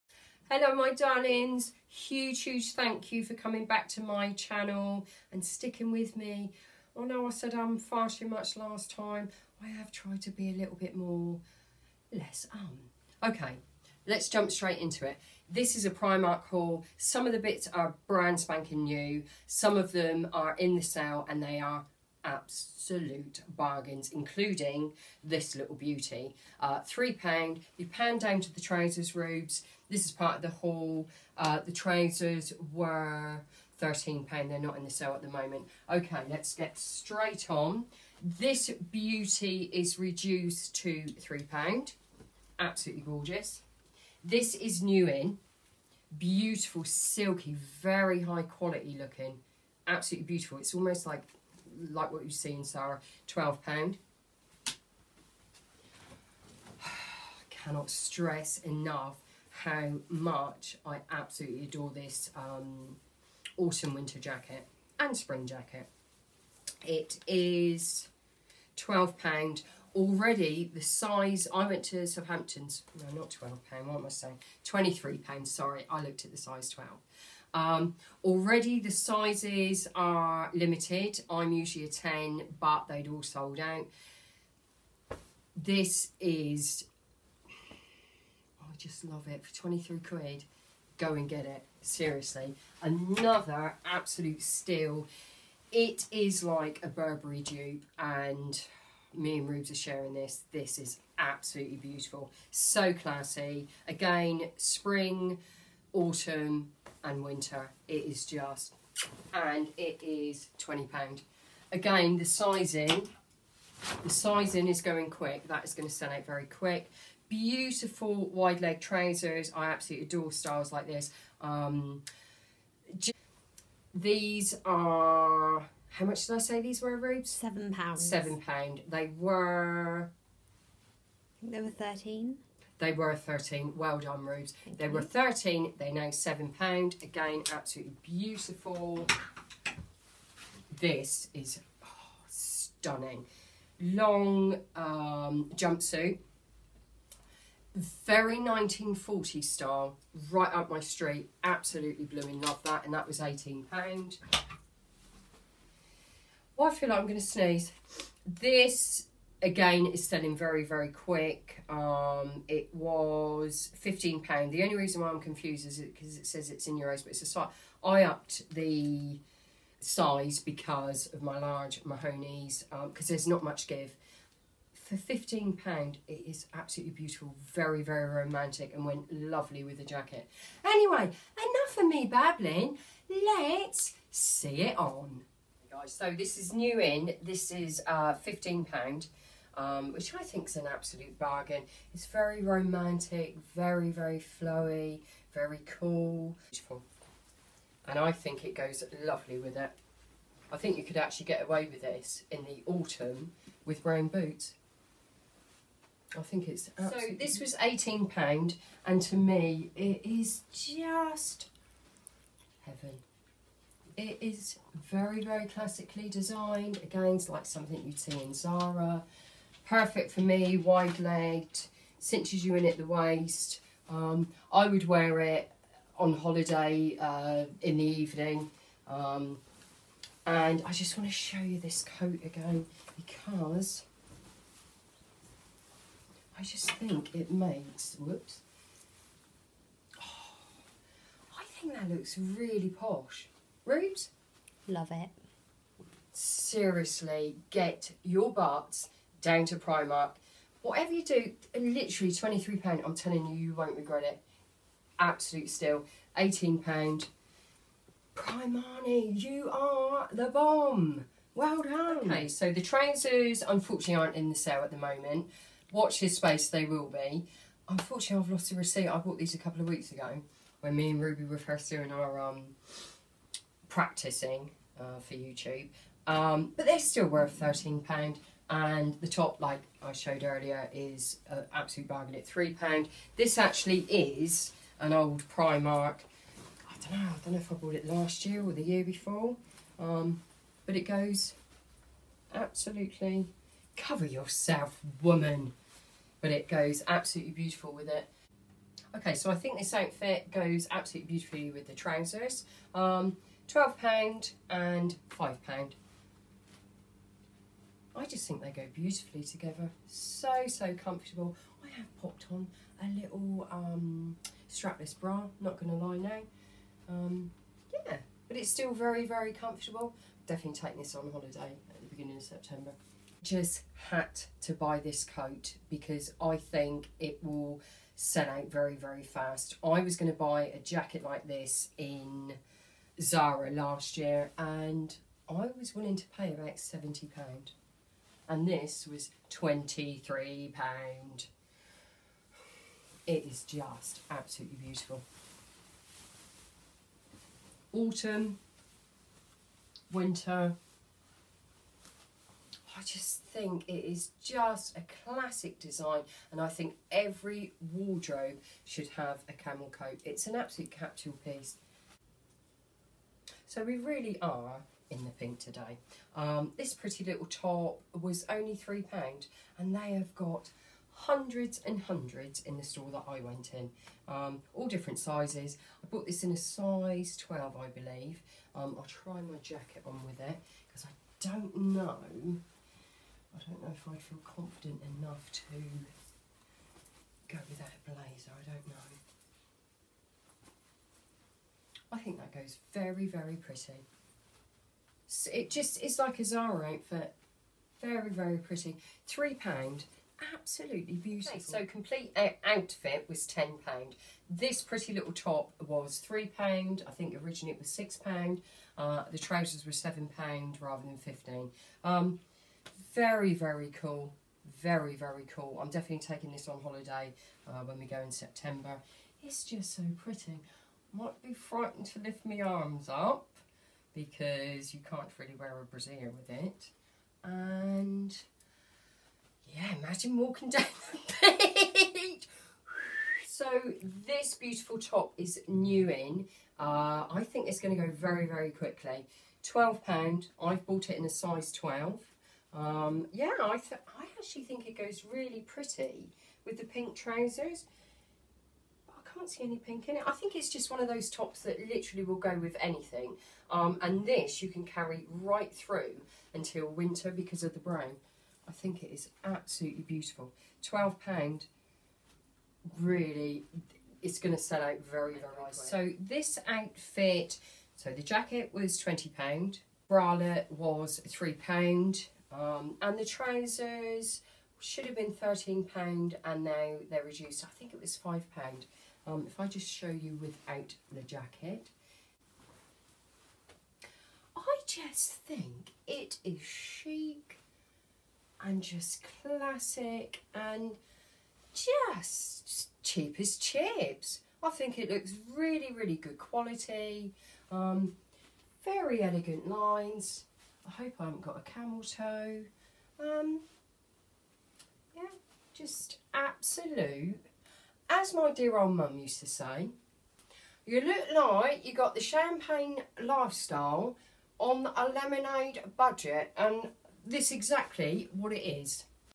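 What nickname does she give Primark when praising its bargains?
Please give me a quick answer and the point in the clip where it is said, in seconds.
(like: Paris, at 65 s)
Primani, at 258 s.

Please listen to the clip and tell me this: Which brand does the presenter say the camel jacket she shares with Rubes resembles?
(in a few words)
Burberry.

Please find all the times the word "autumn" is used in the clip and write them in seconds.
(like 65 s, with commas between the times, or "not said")
63 s, 105 s, 202 s, 347 s.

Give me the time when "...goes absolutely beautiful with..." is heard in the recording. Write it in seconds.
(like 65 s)
296 s.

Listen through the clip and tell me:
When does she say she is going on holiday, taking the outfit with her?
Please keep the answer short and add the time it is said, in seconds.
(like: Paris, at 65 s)
beginning of September, at 321 s.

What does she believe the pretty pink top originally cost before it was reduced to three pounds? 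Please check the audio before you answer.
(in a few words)
£6.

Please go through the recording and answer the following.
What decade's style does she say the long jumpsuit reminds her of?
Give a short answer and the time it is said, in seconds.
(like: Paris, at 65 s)
1940s, at 148 s.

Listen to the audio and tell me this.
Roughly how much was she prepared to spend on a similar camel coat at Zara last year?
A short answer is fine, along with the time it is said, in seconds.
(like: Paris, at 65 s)
£70, at 336 s.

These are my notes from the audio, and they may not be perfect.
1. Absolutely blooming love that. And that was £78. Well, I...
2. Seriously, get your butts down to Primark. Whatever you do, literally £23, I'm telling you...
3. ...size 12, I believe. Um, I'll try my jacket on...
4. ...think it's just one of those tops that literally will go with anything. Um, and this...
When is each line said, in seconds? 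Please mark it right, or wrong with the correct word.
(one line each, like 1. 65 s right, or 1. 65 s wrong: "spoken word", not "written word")
1. 151 s wrong: "18", not "78"
2. 246 s right
3. 376 s right
4. 450 s right.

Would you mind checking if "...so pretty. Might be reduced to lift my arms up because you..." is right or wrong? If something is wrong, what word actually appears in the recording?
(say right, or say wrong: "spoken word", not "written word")
wrong: "frightened", not "reduced".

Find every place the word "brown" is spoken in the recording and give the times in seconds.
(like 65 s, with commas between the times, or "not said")
203 s, 457 s.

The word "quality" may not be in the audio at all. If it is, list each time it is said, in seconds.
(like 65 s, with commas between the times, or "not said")
48 s, 496 s.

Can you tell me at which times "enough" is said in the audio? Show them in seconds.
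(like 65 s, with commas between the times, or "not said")
58 s, 181 s, 384 s.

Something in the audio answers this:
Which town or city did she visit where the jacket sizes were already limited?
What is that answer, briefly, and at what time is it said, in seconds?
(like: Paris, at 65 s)
Southampton, at 72 s.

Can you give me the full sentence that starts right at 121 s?
Um, these are, how much did I say these were, Rubes?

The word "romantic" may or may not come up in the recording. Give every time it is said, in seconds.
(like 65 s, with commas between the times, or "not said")
178 s, 192 s.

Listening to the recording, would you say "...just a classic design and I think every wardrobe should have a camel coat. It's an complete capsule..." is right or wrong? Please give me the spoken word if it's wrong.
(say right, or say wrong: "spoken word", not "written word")
wrong: "absolute", not "complete".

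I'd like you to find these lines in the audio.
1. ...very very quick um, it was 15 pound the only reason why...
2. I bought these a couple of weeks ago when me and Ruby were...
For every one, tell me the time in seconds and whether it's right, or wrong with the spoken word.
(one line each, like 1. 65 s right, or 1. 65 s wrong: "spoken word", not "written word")
1. 160 s right
2. 268 s right.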